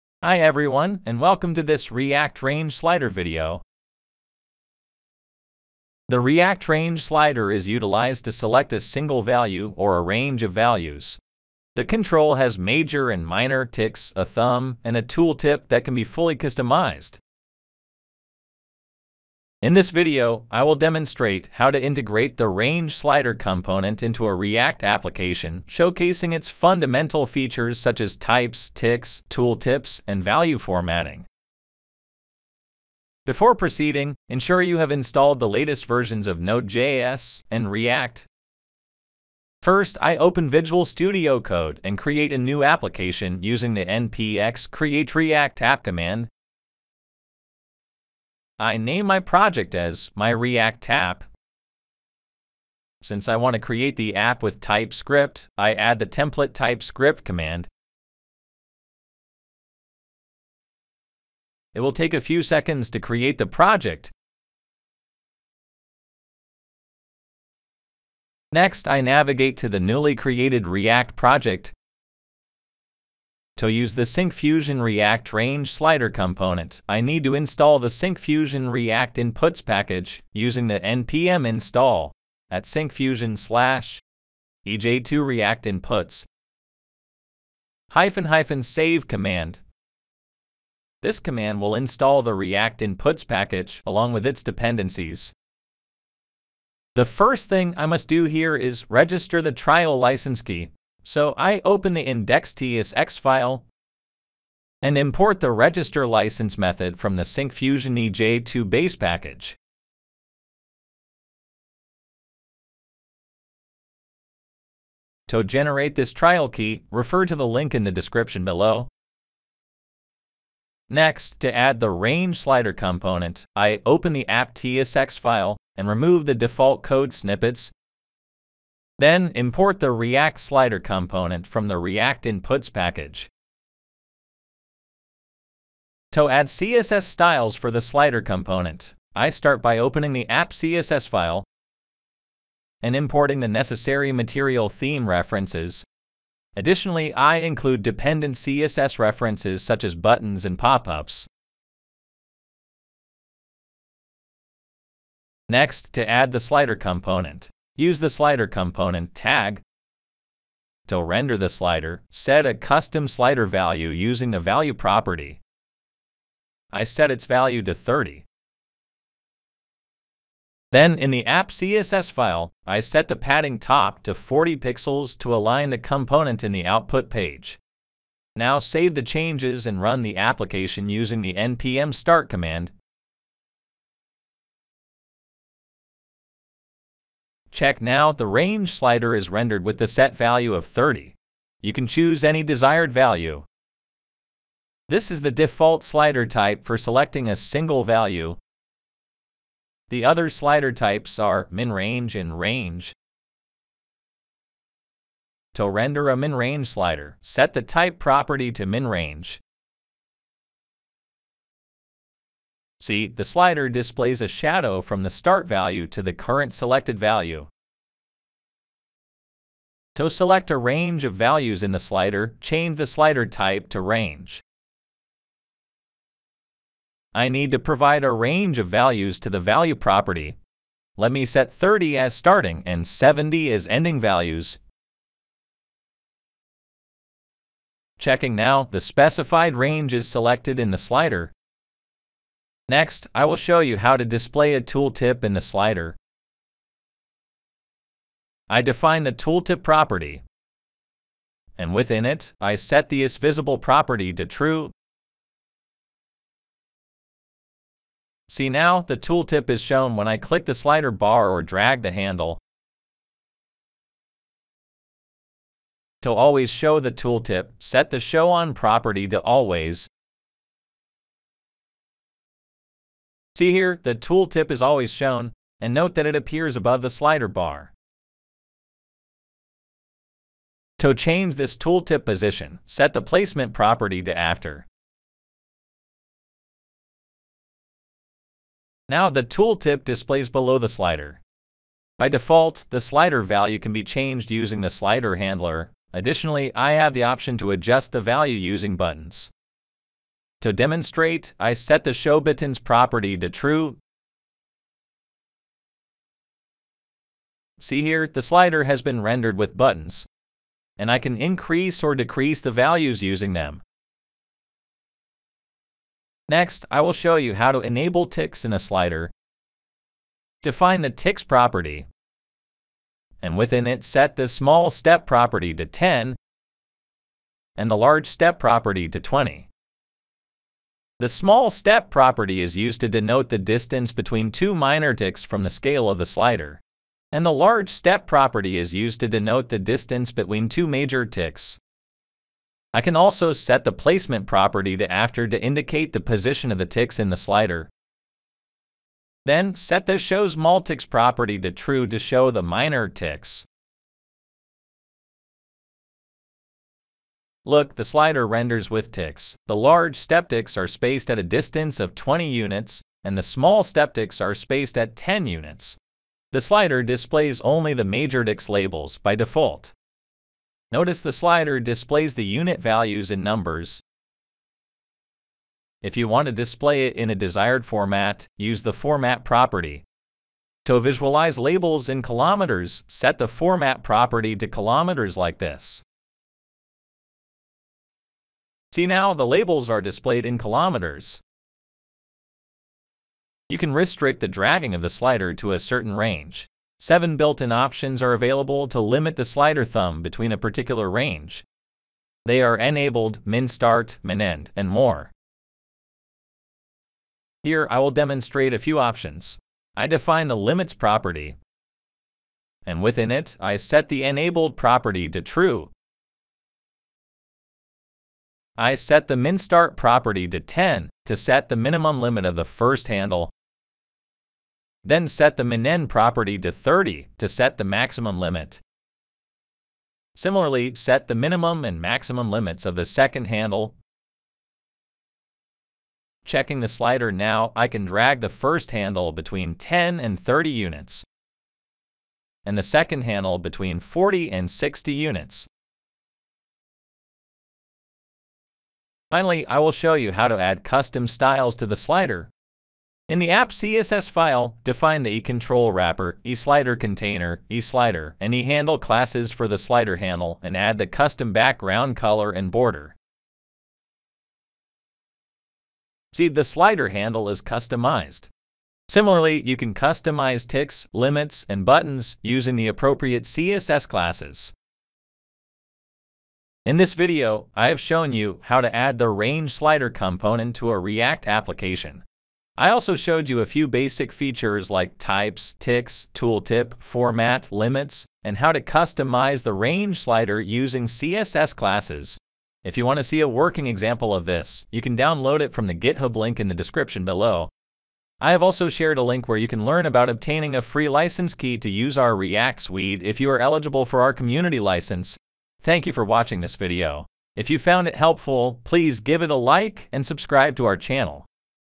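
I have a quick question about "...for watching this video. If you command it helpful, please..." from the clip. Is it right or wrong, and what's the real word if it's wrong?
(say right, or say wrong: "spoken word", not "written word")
wrong: "found", not "command".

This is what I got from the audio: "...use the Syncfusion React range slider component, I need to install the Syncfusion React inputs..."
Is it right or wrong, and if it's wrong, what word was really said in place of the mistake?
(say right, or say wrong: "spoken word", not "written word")
right.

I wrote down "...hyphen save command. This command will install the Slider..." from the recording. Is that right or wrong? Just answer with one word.
wrong.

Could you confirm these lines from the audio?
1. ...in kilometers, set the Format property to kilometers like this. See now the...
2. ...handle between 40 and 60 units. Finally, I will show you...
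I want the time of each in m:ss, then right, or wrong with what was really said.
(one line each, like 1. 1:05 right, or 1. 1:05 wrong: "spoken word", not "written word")
1. 6:21 right
2. 7:23 right.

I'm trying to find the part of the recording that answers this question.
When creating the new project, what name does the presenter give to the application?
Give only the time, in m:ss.
0:50.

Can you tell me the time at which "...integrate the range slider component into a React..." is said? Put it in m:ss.
0:21.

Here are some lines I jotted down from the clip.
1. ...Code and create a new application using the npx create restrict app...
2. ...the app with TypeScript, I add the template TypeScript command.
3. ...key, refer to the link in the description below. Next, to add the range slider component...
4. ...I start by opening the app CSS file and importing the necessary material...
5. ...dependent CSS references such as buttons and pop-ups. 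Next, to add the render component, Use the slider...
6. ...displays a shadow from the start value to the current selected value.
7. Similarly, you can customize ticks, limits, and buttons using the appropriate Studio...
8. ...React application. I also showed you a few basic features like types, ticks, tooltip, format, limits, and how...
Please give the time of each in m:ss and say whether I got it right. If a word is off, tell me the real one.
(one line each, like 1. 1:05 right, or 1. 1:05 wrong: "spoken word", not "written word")
1. 0:41 wrong: "react", not "restrict"
2. 0:53 right
3. 1:56 right
4. 2:19 right
5. 2:27 wrong: "slider", not "render"
6. 3:33 right
7. 7:48 wrong: "CSS", not "Studio"
8. 8:00 right.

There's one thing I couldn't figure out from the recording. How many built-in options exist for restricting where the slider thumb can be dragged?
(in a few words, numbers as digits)
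7.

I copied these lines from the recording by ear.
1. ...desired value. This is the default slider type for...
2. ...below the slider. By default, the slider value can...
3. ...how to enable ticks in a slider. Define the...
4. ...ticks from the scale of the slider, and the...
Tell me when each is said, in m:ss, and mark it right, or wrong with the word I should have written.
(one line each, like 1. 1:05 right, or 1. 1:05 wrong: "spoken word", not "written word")
1. 3:12 right
2. 4:50 right
3. 5:17 right
4. 5:34 right.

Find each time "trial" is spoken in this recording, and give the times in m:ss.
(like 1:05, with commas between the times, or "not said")
1:39, 1:56.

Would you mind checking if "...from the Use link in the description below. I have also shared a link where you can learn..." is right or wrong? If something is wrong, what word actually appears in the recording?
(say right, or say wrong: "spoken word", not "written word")
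wrong: "GitHub", not "Use".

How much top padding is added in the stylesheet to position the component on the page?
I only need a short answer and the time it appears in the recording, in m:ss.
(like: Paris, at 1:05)
40 pixels, at 2:54.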